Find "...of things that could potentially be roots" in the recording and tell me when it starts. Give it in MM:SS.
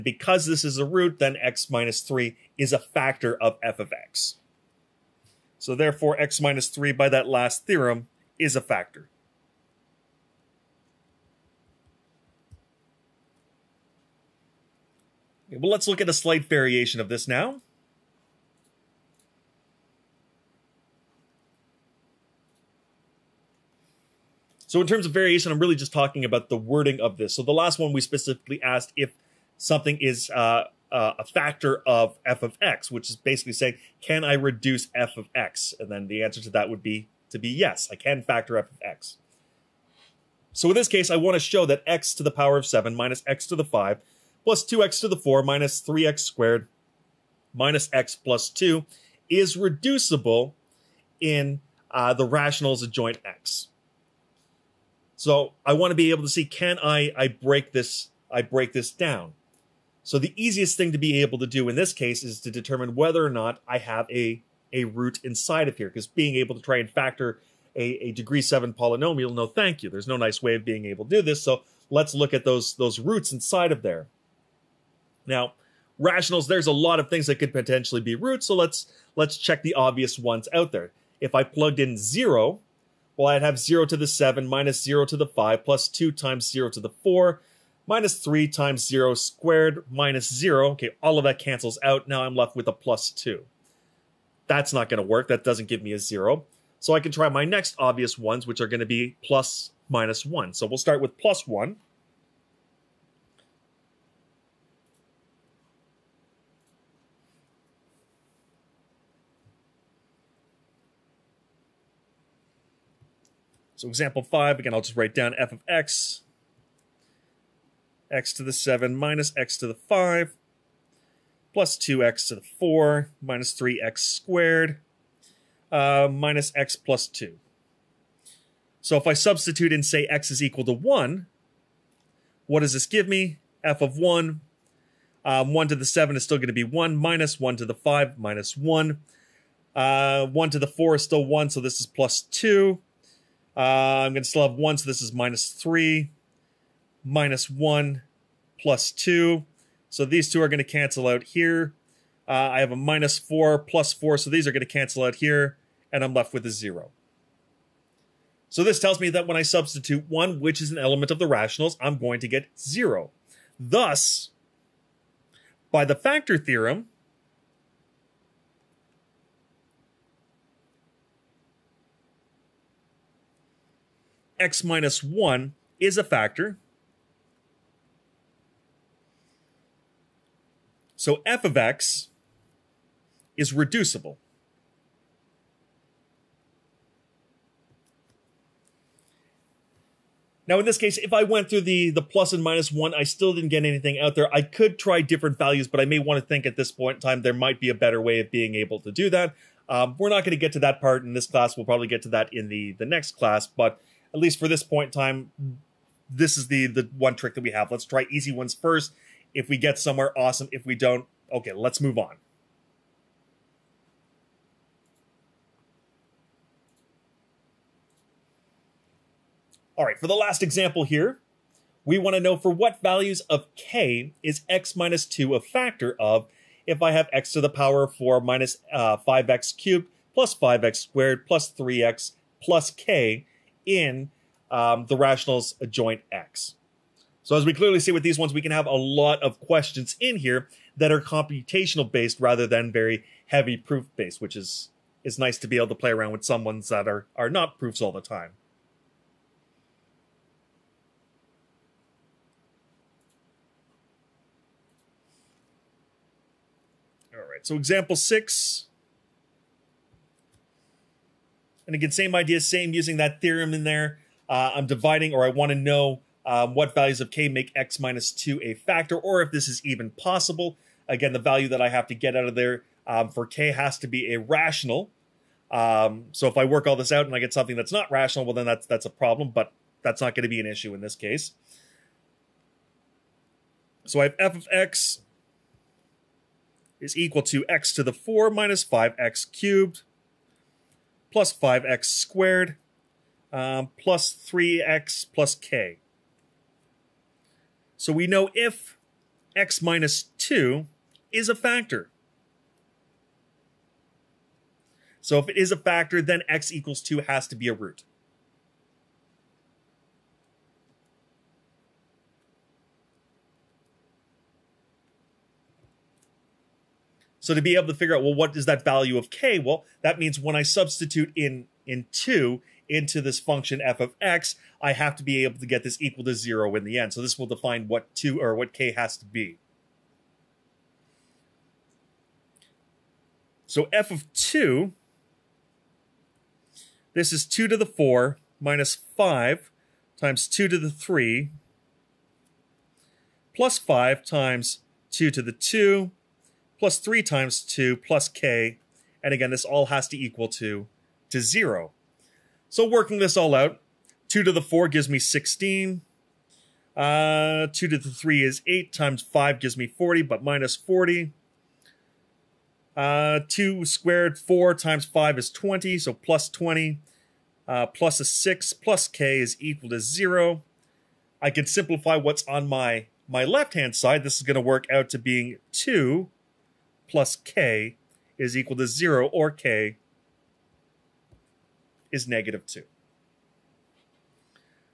01:17.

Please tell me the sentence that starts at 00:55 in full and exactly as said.
So I want to be able to see can I I break this I break this down.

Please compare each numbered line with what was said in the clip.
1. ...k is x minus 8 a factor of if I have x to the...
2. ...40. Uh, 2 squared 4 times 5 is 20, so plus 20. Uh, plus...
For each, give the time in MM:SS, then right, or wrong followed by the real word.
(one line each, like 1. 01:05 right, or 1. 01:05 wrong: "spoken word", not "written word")
1. 03:43 wrong: "2", not "8"
2. 06:00 right.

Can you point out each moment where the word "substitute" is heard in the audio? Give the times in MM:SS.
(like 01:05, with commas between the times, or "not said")
02:09, 02:39, 05:20.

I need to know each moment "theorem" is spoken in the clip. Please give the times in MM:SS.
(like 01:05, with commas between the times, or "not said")
00:07, 02:46, 04:23.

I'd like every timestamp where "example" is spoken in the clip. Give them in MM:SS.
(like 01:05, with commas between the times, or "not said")
01:53, 03:40, 04:17.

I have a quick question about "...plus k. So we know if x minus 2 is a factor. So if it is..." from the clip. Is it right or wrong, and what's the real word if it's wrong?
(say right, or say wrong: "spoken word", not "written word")
right.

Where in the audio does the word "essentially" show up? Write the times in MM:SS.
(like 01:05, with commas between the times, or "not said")
not said.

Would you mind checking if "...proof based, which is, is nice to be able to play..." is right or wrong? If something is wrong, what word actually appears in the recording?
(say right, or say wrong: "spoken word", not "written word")
right.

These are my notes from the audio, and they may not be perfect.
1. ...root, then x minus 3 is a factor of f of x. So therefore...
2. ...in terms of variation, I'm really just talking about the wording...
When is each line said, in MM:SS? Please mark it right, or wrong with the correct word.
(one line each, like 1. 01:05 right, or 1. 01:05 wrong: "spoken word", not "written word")
1. 00:00 right
2. 00:24 right.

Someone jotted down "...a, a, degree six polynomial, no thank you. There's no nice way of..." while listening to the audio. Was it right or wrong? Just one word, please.
wrong.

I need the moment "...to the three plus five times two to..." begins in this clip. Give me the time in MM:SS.
05:40.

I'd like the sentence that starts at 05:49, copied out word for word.
And again, this all has to equal to, to 0.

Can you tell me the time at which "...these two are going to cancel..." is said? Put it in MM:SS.
02:30.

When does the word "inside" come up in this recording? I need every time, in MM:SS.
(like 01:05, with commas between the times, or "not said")
01:05, 01:13.